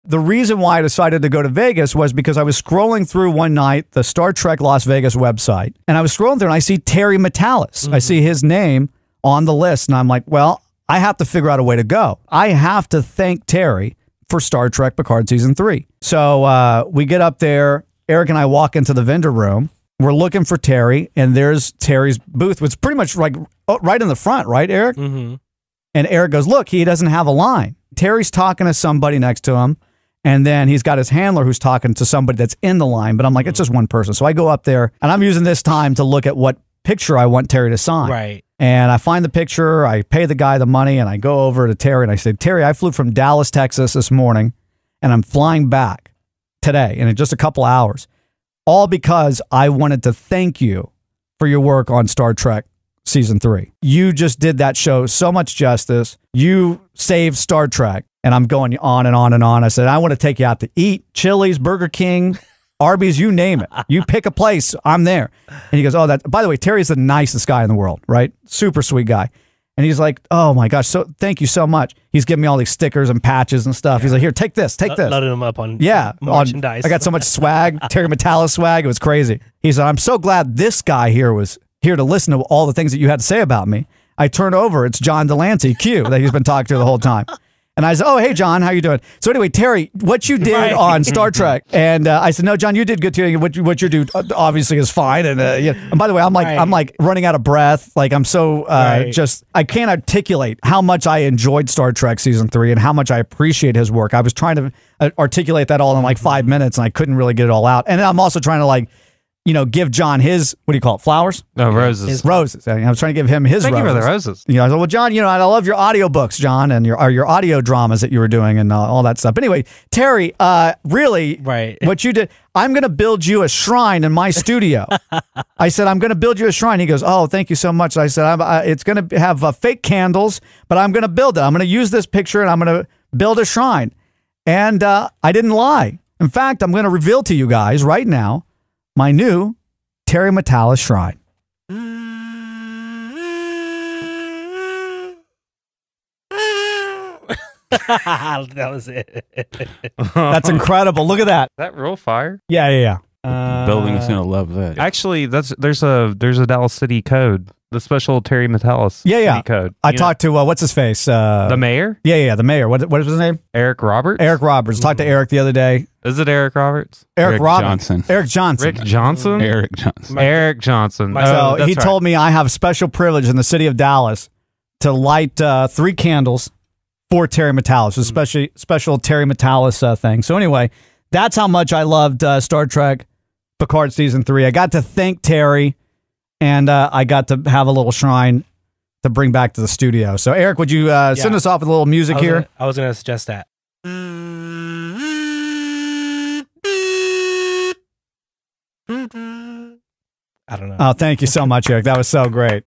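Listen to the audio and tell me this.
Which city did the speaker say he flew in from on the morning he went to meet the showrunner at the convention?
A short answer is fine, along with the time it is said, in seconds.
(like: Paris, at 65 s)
Dallas, Texas, at 43 s.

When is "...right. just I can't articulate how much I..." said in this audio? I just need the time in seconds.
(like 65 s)
99 s.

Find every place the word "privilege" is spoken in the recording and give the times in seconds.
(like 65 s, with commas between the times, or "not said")
172 s.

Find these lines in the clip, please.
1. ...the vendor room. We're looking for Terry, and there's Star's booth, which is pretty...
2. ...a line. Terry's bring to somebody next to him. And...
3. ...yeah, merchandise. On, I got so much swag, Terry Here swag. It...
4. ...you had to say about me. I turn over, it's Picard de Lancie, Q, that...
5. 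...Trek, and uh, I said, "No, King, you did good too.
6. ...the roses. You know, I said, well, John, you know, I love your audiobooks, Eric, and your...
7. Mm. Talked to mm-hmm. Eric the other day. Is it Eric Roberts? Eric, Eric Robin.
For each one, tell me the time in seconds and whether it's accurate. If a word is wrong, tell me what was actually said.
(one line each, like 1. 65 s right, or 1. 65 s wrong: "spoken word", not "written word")
1. 18 s wrong: "Terry", not "Star"
2. 27 s wrong: "talking", not "bring"
3. 75 s wrong: "Matalas", not "Here"
4. 82 s wrong: "John", not "Picard"
5. 91 s wrong: "John", not "King"
6. 113 s wrong: "John", not "Eric"
7. 164 s right.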